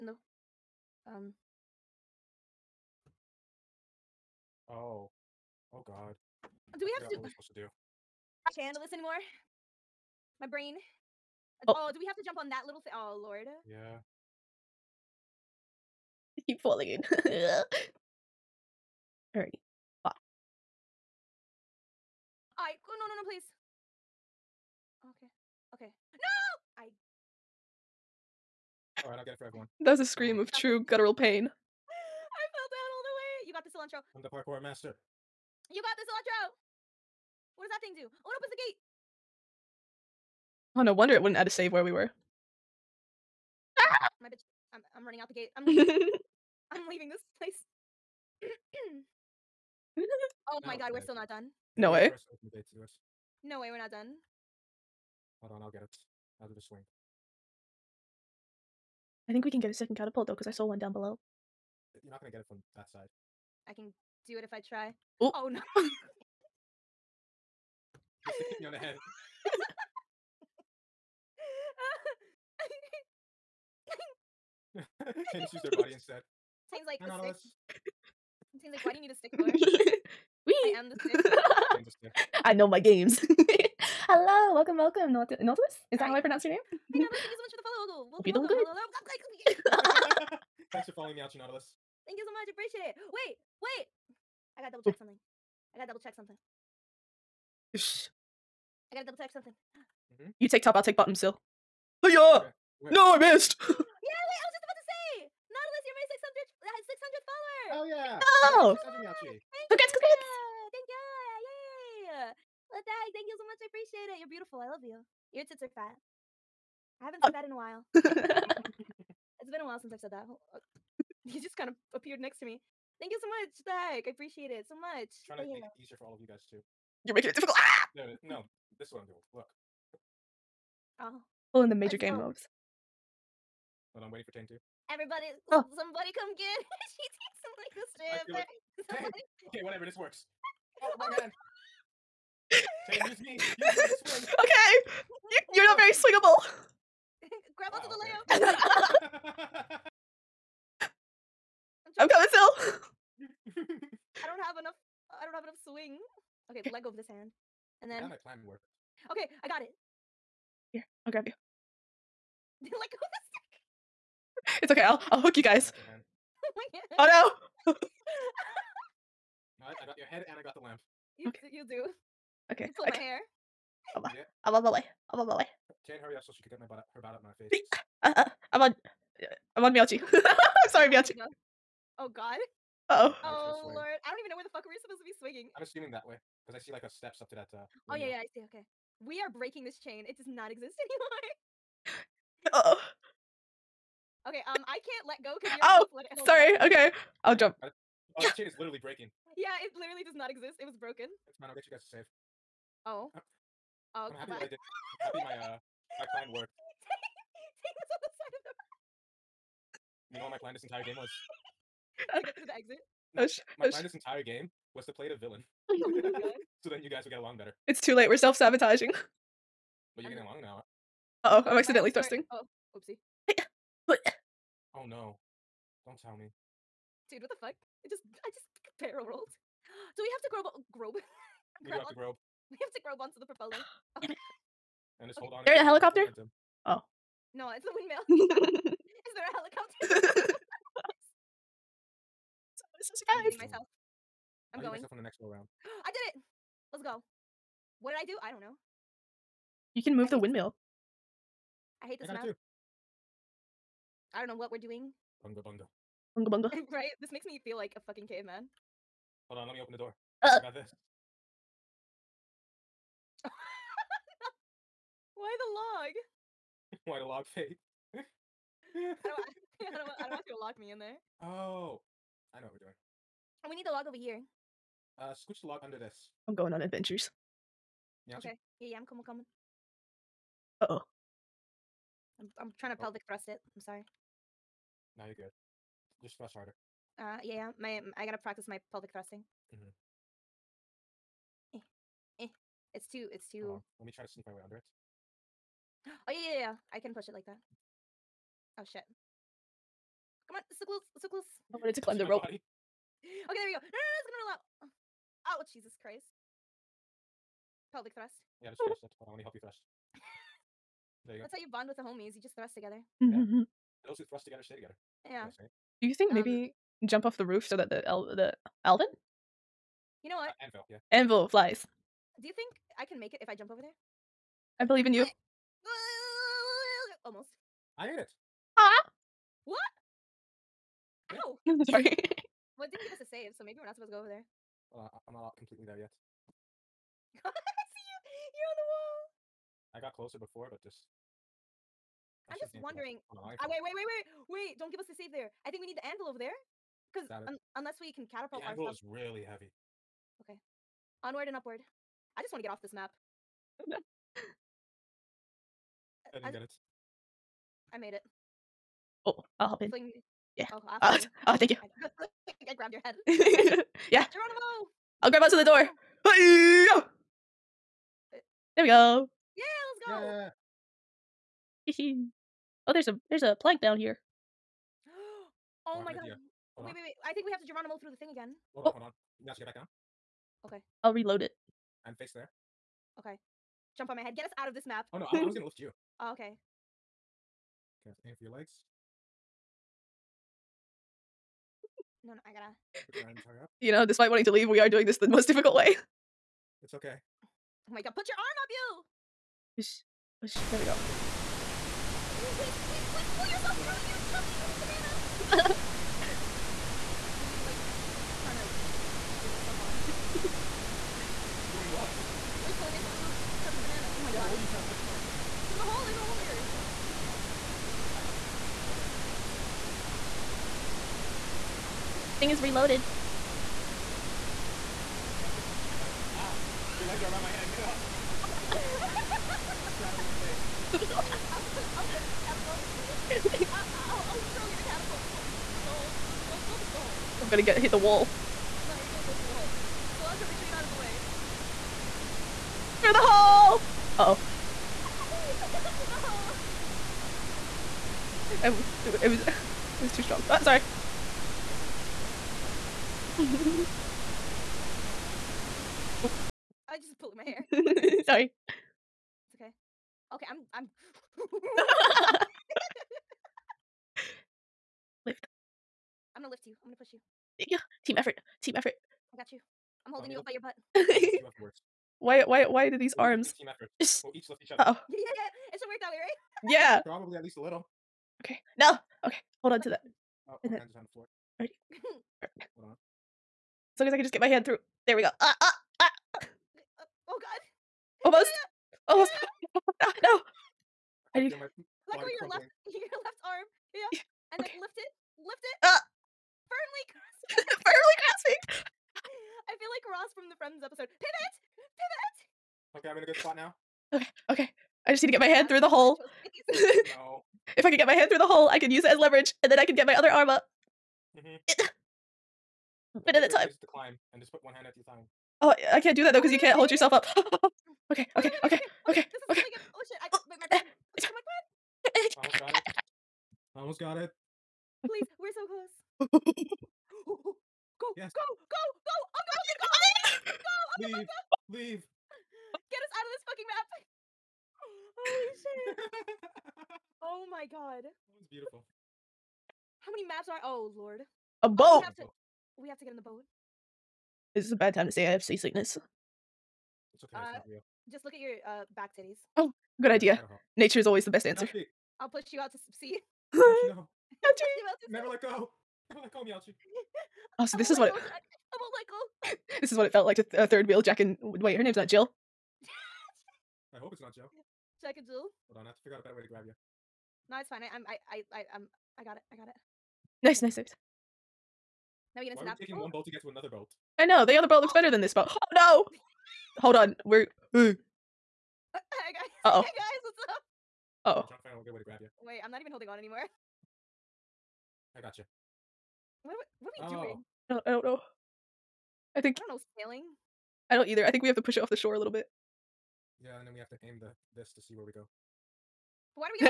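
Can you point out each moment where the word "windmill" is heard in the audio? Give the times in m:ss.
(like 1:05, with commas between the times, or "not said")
3:57, 4:10.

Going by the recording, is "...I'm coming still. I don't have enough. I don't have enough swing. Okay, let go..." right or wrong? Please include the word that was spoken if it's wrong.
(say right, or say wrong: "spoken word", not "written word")
right.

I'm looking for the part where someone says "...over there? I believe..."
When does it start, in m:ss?
5:23.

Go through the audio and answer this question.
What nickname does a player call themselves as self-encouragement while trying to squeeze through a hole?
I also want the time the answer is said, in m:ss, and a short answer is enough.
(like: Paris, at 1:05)
chubby little banana, at 6:43.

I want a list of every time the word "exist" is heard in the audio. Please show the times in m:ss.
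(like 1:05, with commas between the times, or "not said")
3:10, 3:20.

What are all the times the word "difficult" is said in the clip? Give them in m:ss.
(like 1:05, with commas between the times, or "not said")
2:07, 6:35.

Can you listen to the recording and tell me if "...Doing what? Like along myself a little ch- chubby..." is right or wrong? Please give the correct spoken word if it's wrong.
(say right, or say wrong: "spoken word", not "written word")
wrong: "calling", not "along".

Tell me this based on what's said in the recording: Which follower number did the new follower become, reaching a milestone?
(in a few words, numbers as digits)
600th.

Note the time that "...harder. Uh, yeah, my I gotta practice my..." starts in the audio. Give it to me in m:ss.
4:46.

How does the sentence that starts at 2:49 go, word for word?
right, I got your head and I got the lamp.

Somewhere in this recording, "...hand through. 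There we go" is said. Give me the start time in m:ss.
8:04.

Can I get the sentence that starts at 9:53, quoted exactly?
Yeah, and then we have to aim the this to see where we go.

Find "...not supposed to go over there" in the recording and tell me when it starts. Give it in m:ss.
5:33.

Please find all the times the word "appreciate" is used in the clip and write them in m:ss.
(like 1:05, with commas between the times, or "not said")
1:32, 1:53, 2:04.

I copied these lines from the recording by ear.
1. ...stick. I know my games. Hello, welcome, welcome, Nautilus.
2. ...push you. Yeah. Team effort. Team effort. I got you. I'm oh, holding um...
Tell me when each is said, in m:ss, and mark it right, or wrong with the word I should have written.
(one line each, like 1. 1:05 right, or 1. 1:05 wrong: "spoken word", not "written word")
1. 1:21 right
2. 7:46 right.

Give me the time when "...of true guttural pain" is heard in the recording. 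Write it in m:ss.
0:30.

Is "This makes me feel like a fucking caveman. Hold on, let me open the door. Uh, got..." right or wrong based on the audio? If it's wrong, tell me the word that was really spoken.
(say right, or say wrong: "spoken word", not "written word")
right.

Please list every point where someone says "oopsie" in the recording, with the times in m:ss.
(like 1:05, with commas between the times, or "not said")
3:42.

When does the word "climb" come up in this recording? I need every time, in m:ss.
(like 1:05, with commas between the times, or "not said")
5:01, 8:33.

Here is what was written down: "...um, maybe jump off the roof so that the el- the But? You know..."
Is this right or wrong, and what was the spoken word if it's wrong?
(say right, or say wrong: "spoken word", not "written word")
wrong: "Alvin", not "But".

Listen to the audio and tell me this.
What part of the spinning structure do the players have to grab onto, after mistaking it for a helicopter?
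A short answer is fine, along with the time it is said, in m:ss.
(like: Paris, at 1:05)
the propeller, at 3:52.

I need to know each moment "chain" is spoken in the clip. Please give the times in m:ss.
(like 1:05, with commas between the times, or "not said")
3:09, 3:18.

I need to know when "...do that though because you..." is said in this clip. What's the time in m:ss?
8:35.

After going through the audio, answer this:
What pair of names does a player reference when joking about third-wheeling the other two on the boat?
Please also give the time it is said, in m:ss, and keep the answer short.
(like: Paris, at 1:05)
Jack and Jill, at 9:24.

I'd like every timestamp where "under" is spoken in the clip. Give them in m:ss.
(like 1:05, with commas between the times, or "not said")
4:35, 4:54.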